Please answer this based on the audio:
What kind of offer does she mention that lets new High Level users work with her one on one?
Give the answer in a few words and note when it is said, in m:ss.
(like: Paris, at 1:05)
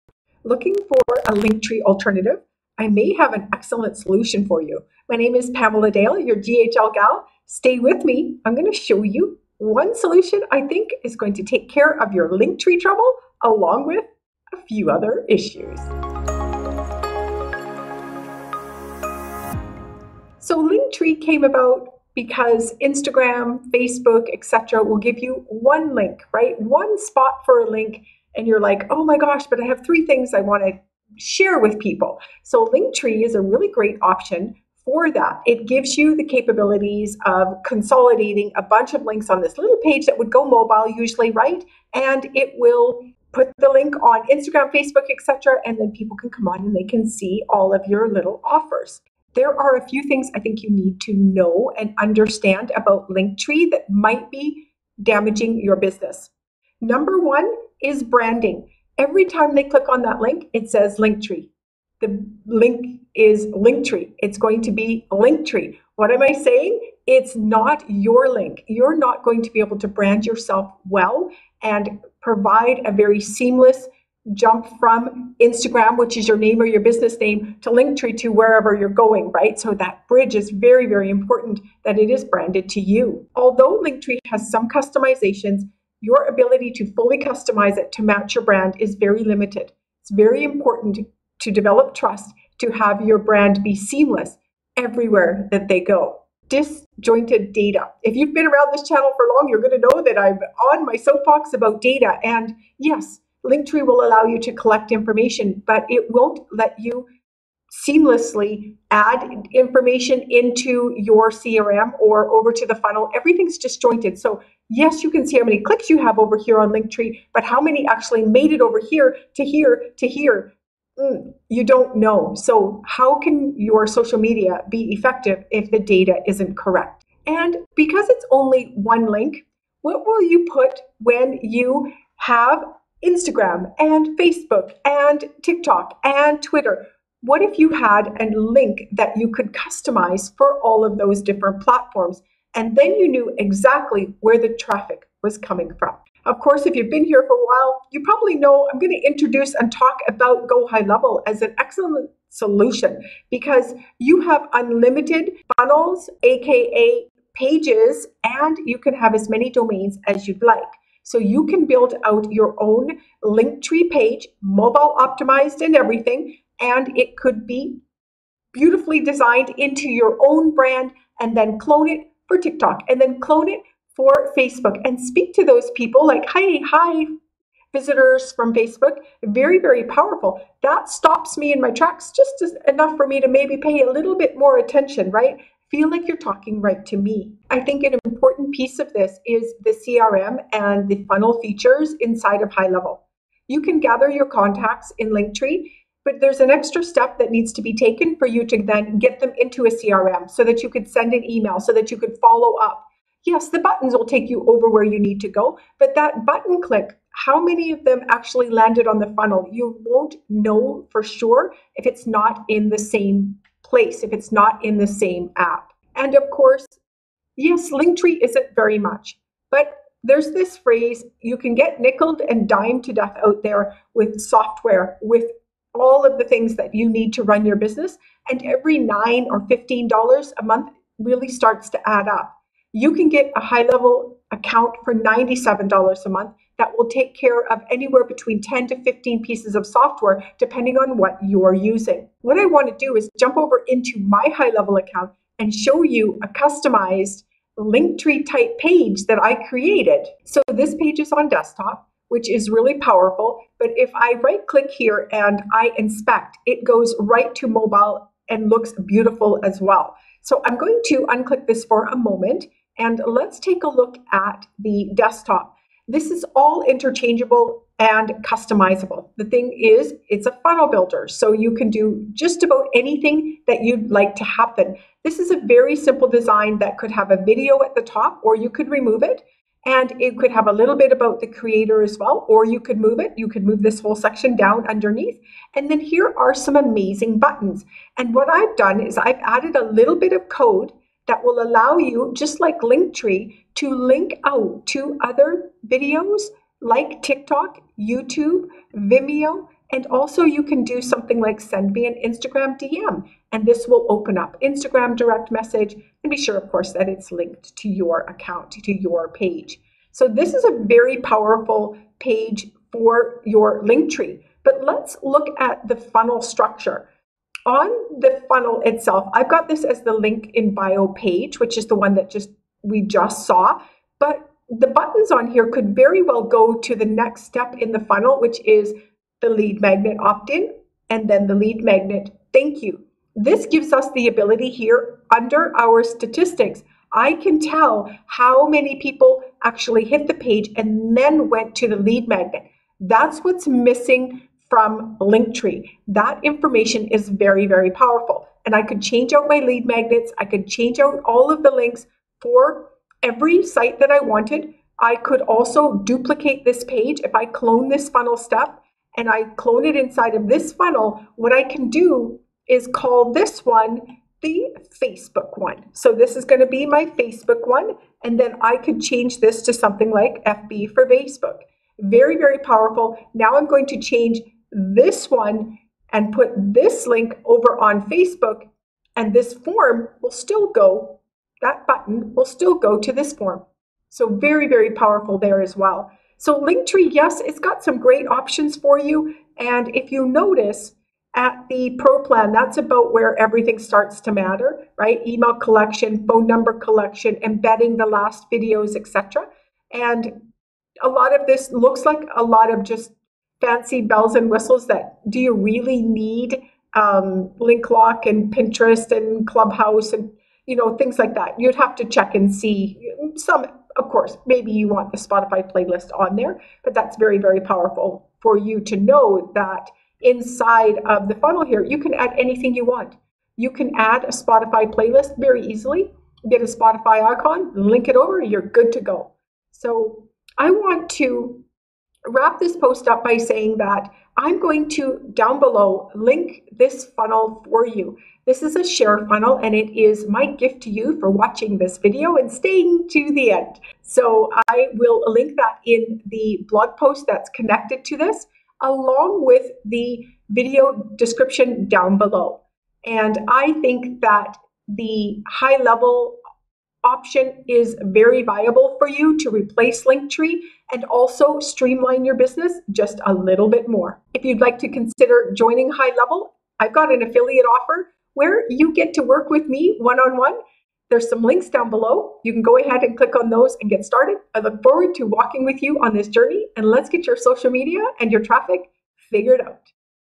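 affiliate offer, at 7:47.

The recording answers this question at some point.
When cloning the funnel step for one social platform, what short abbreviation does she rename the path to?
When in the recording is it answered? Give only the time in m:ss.
6:10.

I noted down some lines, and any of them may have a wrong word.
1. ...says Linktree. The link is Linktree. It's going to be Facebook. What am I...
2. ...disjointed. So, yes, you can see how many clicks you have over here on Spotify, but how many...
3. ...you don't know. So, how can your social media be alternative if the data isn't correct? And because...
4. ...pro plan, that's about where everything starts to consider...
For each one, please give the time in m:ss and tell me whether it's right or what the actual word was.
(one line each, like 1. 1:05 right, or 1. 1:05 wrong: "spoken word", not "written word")
1. 1:00 wrong: "Linktree", not "Facebook"
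2. 1:53 wrong: "Linktree", not "Spotify"
3. 2:01 wrong: "effective", not "alternative"
4. 6:31 wrong: "matter", not "consider".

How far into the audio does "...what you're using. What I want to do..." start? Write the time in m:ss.
4:00.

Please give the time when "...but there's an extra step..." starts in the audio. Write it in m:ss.
3:16.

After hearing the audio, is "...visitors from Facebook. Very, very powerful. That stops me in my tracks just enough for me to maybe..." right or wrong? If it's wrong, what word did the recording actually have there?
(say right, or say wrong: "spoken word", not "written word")
right.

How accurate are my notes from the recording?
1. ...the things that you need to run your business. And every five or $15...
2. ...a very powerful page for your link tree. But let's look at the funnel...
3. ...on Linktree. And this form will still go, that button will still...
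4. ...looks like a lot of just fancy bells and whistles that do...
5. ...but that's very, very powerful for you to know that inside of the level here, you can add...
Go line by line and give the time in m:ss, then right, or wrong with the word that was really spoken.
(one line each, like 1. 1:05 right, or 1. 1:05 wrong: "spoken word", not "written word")
1. 3:46 wrong: "nine", not "five"
2. 5:10 right
3. 6:17 wrong: "Facebook", not "Linktree"
4. 6:41 right
5. 6:56 wrong: "funnel", not "level".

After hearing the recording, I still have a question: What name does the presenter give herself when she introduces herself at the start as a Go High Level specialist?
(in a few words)
Pamela Dale.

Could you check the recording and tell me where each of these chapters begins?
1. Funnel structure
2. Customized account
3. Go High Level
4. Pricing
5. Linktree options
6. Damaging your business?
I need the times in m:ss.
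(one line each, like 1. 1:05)
1. 5:13
2. 4:03
3. 2:26
4. 3:36
5. 6:26
6. 0:49.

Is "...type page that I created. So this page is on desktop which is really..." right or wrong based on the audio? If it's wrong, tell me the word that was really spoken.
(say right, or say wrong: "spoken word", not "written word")
right.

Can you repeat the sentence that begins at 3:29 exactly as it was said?
You won't know for sure if it's not in the same place, if it's not in the same app.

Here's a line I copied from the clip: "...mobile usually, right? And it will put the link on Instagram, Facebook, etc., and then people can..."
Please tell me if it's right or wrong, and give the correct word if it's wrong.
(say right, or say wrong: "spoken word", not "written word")
right.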